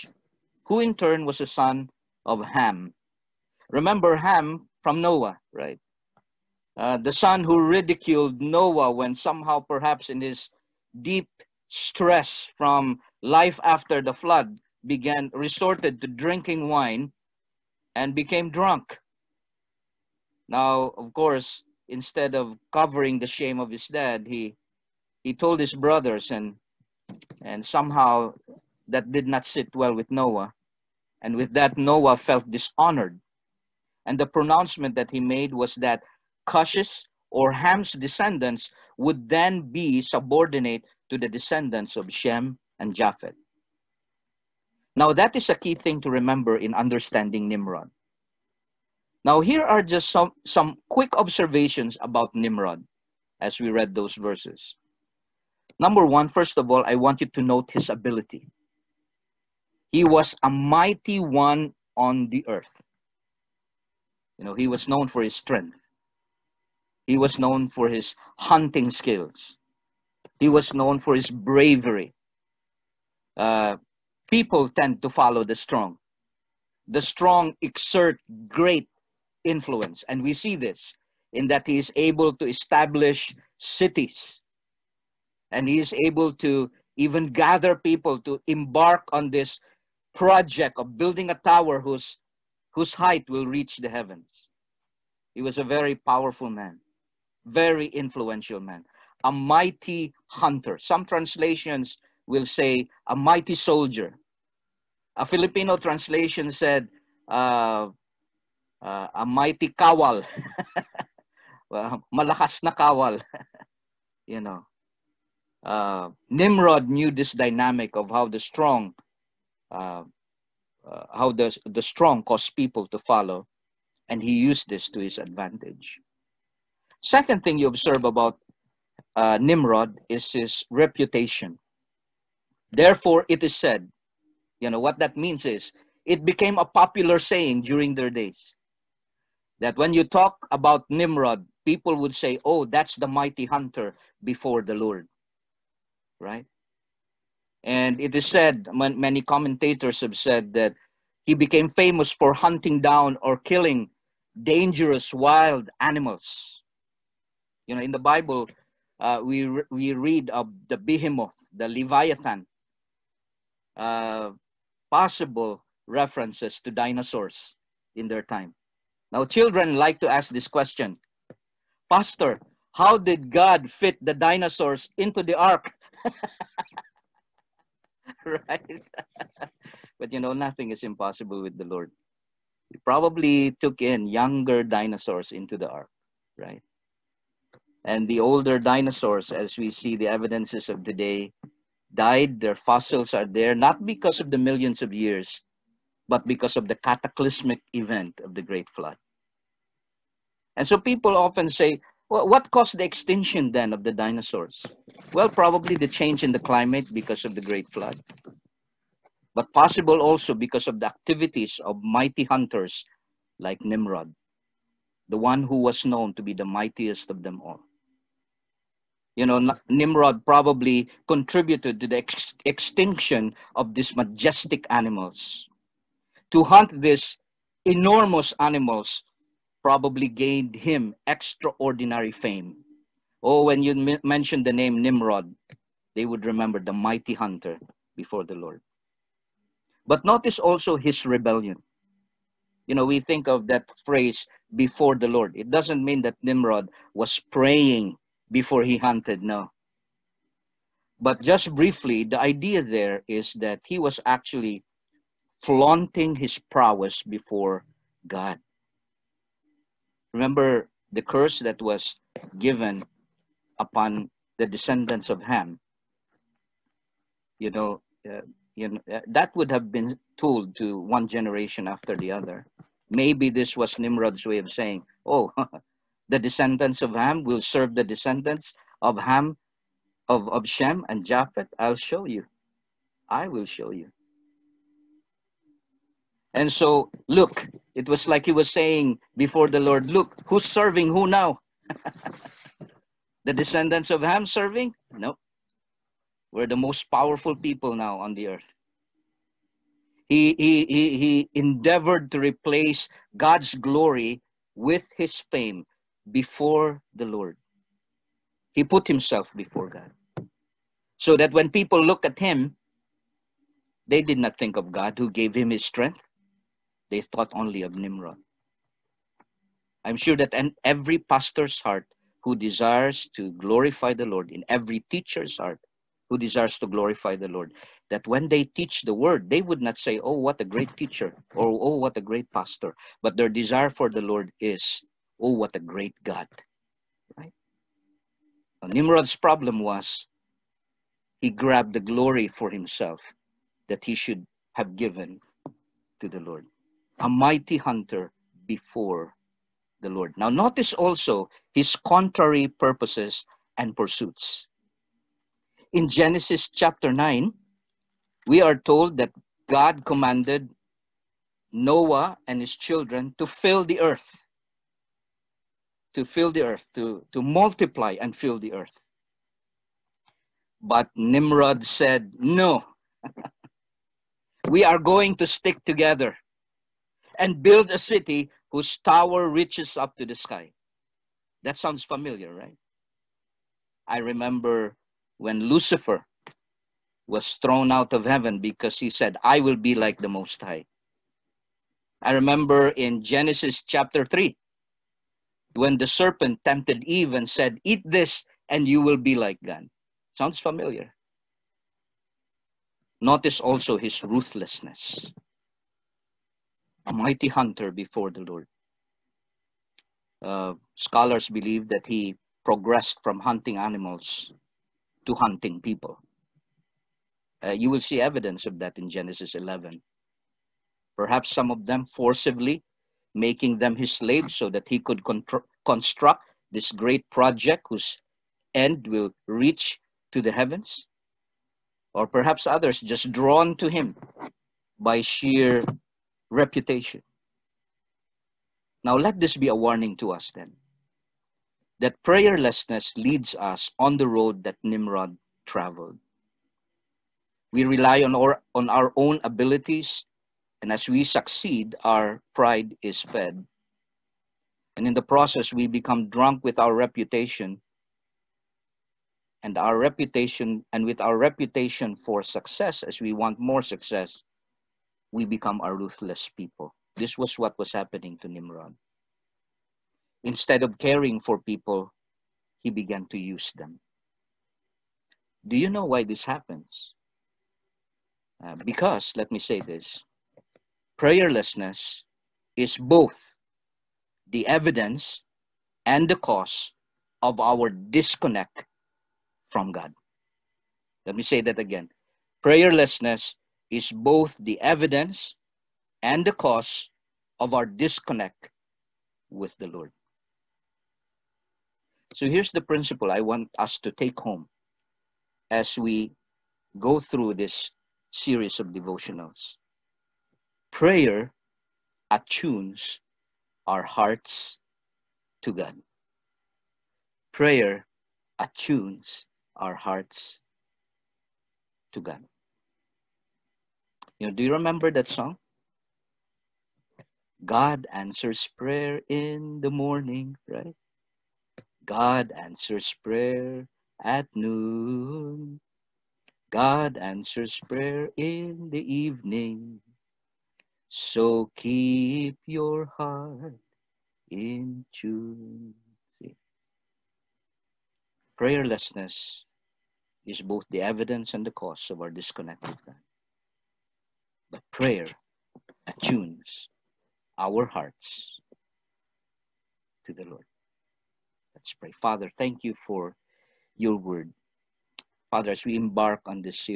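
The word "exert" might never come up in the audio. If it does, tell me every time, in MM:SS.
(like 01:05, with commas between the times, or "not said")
01:17.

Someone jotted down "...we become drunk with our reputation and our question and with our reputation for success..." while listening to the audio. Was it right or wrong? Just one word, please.
wrong.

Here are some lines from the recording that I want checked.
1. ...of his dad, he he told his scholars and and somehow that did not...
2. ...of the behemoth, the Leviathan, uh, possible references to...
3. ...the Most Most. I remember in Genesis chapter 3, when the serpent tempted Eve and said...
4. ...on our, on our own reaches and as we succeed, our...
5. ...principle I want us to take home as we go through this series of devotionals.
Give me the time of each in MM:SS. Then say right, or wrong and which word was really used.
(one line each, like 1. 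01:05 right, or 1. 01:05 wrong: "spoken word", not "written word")
1. 00:23 wrong: "brothers", not "scholars"
2. 02:40 right
3. 06:30 wrong: "High", not "Most"
4. 07:28 wrong: "abilities", not "reaches"
5. 08:22 right.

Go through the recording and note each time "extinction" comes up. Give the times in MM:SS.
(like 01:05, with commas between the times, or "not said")
03:22, 03:42.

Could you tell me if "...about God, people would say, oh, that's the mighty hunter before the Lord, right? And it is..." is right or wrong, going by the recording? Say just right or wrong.
wrong.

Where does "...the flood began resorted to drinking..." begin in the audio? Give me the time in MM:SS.
00:14.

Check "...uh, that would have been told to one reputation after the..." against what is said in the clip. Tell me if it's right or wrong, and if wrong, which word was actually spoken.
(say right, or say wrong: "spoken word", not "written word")
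wrong: "generation", not "reputation".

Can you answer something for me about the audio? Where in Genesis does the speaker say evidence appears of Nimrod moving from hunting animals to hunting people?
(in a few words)
Genesis 11.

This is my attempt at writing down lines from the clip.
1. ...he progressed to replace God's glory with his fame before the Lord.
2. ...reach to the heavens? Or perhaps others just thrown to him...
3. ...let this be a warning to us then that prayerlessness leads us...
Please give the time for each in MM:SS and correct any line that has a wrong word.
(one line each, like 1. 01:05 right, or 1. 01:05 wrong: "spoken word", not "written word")
1. 05:00 wrong: "endeavored", not "progressed"
2. 07:09 wrong: "drawn", not "thrown"
3. 07:18 right.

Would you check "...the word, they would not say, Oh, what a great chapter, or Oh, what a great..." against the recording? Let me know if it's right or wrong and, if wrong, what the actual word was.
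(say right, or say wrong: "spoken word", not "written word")
wrong: "teacher", not "chapter".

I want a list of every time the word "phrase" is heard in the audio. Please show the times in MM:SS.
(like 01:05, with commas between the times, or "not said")
04:03.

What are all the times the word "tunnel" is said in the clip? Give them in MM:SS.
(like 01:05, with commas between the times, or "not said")
not said.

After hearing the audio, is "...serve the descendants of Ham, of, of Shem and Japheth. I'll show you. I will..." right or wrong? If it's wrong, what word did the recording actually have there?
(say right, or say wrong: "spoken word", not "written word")
right.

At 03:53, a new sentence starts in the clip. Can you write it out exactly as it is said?
Oh, when you mention the name Nimrod, they would remember the mighty hunter before the Lord.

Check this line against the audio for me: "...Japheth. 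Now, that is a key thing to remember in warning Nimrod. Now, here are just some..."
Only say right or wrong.
wrong.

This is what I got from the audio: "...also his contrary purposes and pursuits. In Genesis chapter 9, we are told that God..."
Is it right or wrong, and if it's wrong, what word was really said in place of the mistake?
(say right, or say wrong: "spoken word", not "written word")
right.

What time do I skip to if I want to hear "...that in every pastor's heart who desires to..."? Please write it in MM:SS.
05:20.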